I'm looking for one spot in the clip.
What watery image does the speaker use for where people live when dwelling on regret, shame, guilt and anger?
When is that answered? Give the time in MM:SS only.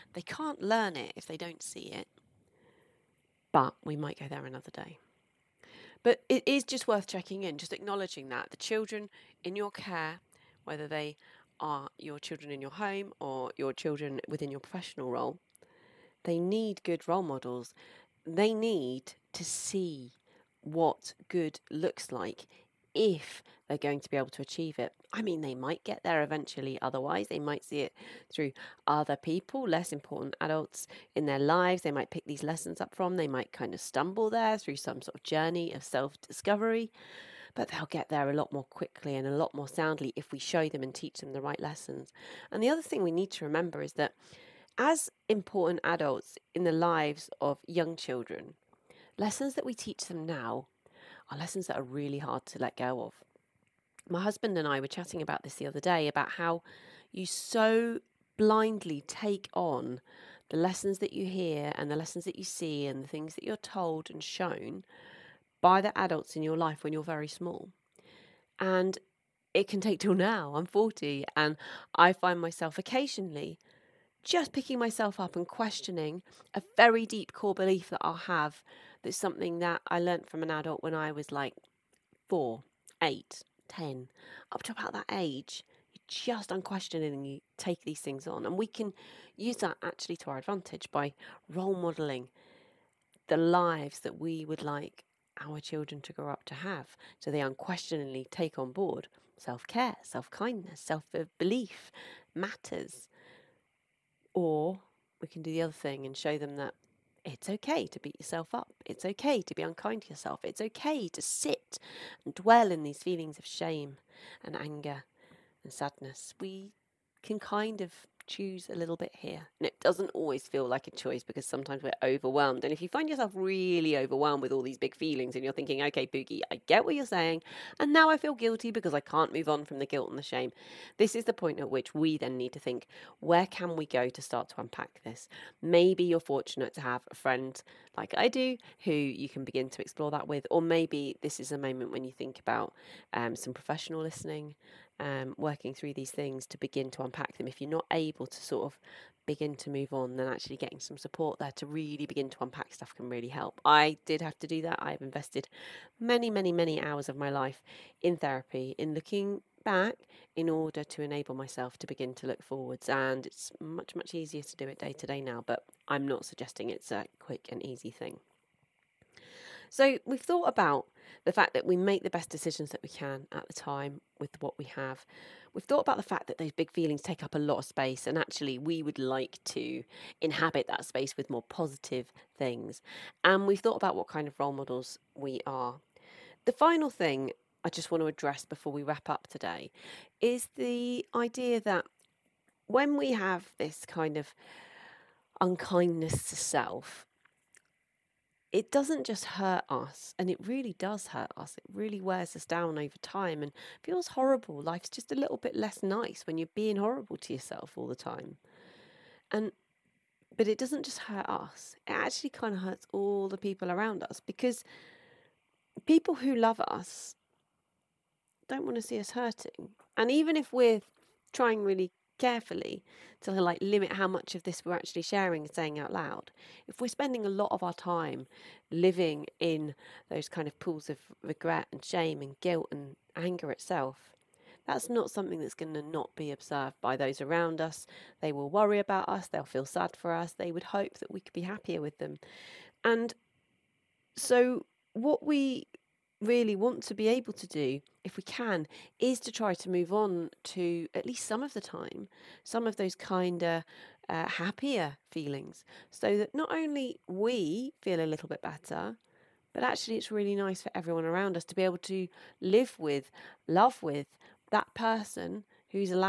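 03:50.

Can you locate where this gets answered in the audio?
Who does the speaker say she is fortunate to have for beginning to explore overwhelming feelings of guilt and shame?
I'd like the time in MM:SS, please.
02:17.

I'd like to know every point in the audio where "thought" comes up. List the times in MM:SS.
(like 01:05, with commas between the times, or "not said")
02:50, 02:55, 03:03.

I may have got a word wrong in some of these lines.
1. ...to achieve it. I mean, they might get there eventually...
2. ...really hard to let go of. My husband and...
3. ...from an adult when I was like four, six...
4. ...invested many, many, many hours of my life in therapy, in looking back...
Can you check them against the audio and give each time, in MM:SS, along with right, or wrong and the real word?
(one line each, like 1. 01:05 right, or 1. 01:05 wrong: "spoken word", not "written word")
1. 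00:24 right
2. 00:51 right
3. 01:20 wrong: "eight", not "six"
4. 02:35 right.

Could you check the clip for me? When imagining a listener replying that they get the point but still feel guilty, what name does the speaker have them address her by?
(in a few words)
Pooky.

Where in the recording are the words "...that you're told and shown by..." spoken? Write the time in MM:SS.
01:03.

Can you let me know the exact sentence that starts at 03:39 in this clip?
And even if we're trying really carefully to like limit how much of this we're actually sharing and saying out loud.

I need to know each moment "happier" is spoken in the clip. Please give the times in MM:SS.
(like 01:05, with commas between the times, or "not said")
04:01, 04:14.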